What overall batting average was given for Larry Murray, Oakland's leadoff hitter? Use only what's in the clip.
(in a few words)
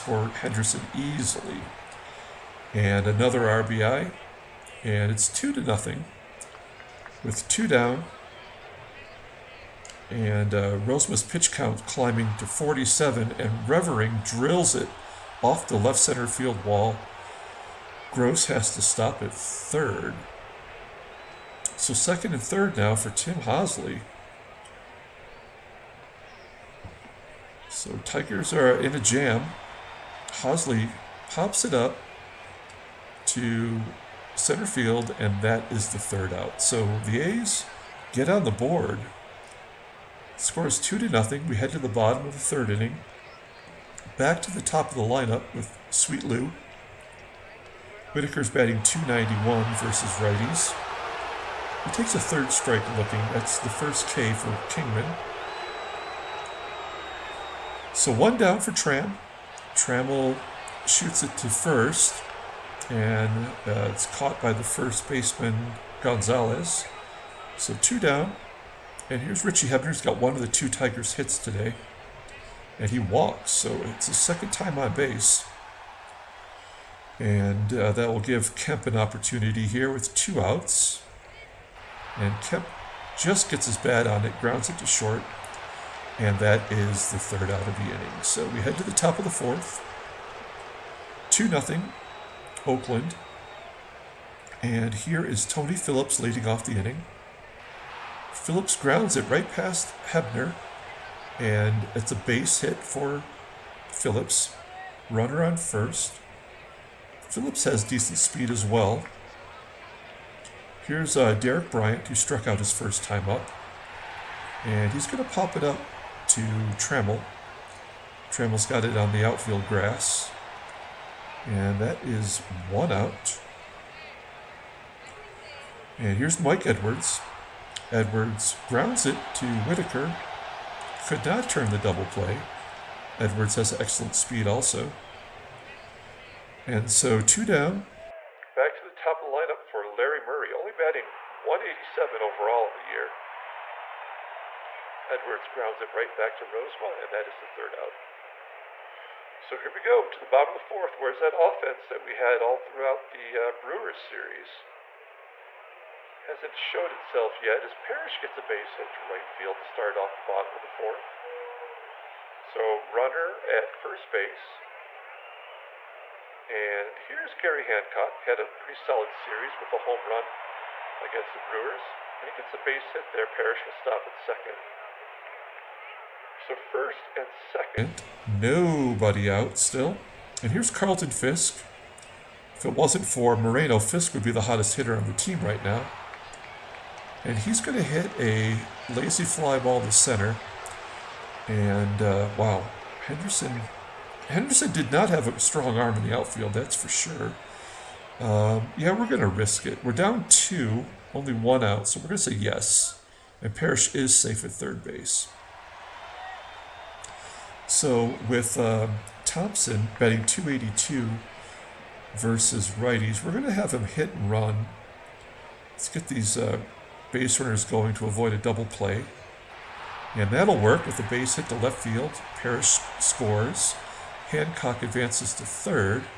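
187.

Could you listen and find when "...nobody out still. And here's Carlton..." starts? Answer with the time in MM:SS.
02:58.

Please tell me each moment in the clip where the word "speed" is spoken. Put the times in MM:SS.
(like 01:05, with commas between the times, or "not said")
01:48, 02:14.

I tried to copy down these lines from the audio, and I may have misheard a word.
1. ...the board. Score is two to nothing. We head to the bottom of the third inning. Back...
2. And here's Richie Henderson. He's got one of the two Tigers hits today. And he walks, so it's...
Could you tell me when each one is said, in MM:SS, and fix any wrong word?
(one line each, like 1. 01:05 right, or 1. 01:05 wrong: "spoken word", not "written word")
1. 00:38 right
2. 01:09 wrong: "Hebner", not "Henderson".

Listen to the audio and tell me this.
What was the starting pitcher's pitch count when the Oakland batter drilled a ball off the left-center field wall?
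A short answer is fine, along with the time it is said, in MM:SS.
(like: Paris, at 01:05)
47, at 00:12.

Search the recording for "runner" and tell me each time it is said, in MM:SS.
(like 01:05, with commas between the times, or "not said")
01:45, 02:42, 03:37.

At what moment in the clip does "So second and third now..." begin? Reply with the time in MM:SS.
00:21.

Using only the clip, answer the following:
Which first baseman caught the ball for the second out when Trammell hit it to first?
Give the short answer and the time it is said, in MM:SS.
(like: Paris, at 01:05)
Gonzalez, at 01:05.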